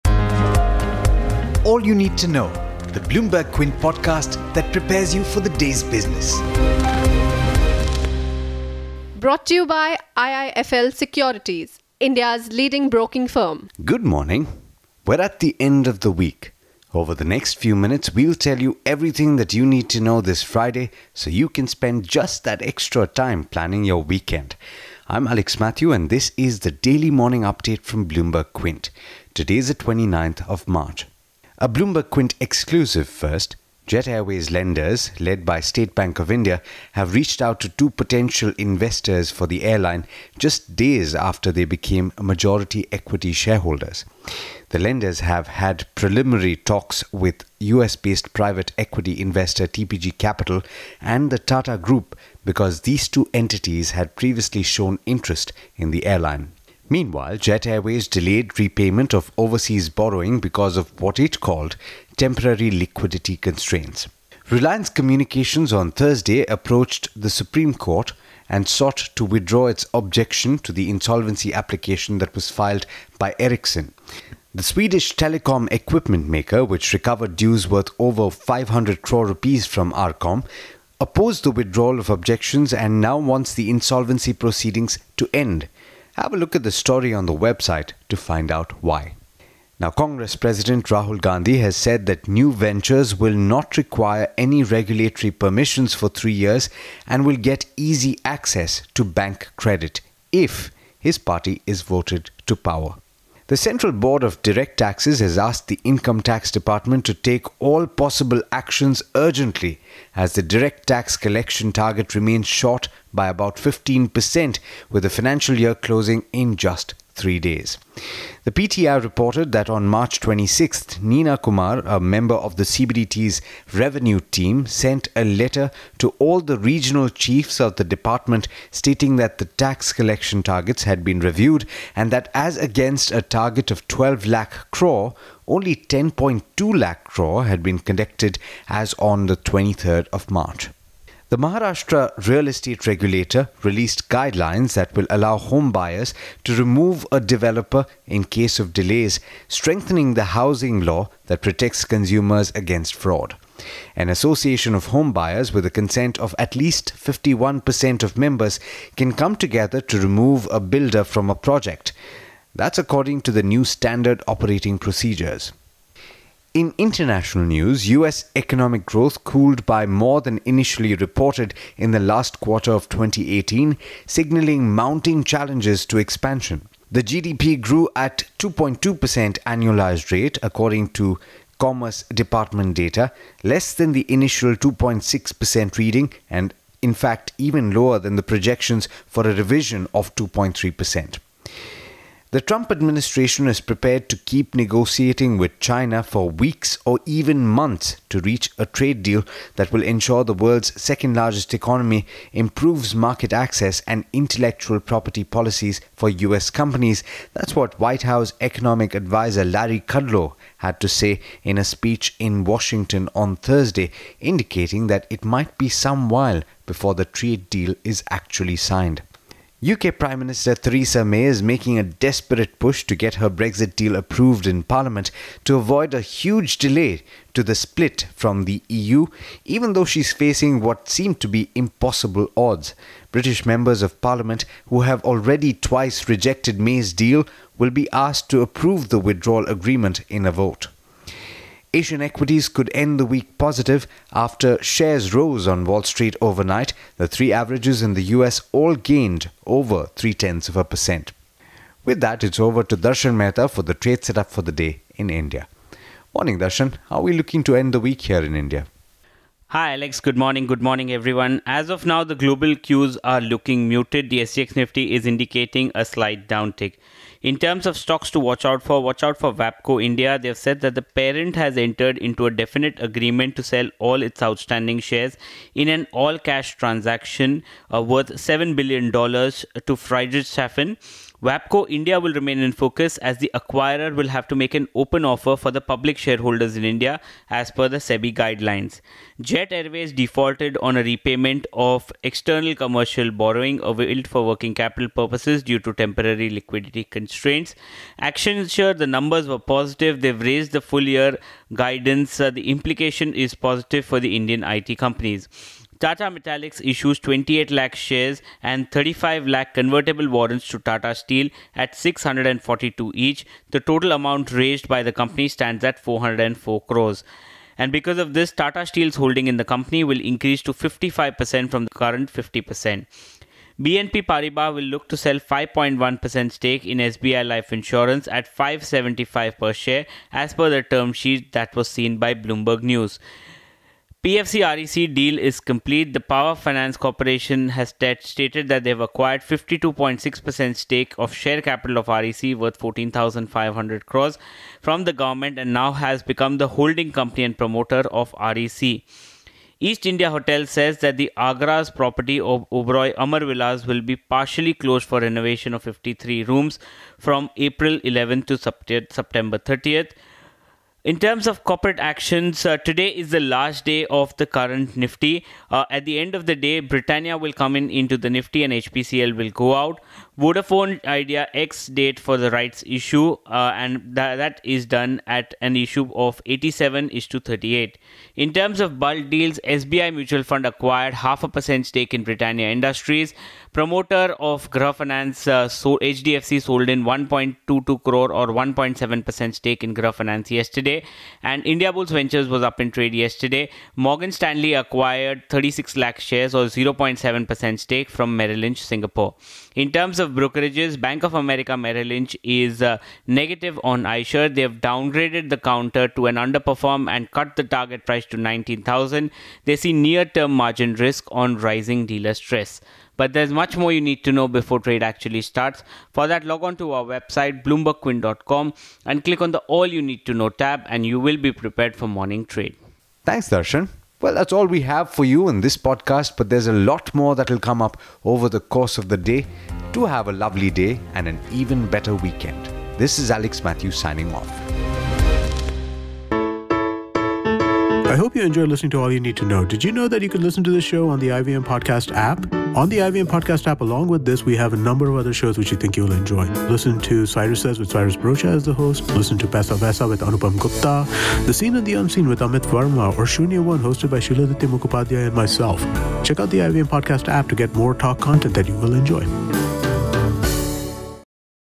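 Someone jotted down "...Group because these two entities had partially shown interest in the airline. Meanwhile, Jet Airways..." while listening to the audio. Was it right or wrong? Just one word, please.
wrong.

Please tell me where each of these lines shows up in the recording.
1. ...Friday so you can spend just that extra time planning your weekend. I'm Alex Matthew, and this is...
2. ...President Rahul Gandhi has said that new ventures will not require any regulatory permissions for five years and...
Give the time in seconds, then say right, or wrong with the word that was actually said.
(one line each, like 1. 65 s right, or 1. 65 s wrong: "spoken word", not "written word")
1. 20 s right
2. 90 s wrong: "three", not "five".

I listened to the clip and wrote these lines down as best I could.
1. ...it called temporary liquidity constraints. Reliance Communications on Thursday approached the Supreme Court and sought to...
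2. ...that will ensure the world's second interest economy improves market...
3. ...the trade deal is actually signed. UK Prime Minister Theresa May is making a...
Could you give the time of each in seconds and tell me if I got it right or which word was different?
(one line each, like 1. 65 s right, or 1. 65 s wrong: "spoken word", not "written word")
1. 61 s right
2. 199 s wrong: "largest", not "interest"
3. 216 s right.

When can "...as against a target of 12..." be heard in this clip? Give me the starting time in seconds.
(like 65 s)
132 s.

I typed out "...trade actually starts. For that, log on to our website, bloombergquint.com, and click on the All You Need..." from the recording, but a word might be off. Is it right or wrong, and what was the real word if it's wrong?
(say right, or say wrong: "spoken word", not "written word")
right.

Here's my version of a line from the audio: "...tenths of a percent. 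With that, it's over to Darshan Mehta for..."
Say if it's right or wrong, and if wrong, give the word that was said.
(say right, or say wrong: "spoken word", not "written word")
right.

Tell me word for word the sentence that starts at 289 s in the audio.
Jet Airways defaulted on a repayment of external commercial borrowing availed for working capital purposes due to temporary liquidity constraints.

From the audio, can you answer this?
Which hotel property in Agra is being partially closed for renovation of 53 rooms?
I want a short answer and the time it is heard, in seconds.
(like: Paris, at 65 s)
Oberoi Amarvilas, at 352 s.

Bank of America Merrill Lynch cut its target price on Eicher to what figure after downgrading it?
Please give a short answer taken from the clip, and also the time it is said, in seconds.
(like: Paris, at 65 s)
19,000, at 408 s.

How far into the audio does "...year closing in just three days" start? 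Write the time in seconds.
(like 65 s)
115 s.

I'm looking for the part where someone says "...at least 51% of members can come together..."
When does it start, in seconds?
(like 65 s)
156 s.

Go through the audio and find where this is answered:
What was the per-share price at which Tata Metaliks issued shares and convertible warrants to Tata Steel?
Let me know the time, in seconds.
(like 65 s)
311 s.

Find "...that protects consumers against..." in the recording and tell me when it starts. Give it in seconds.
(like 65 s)
151 s.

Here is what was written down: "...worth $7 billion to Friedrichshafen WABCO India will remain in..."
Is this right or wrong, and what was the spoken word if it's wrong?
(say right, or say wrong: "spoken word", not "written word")
right.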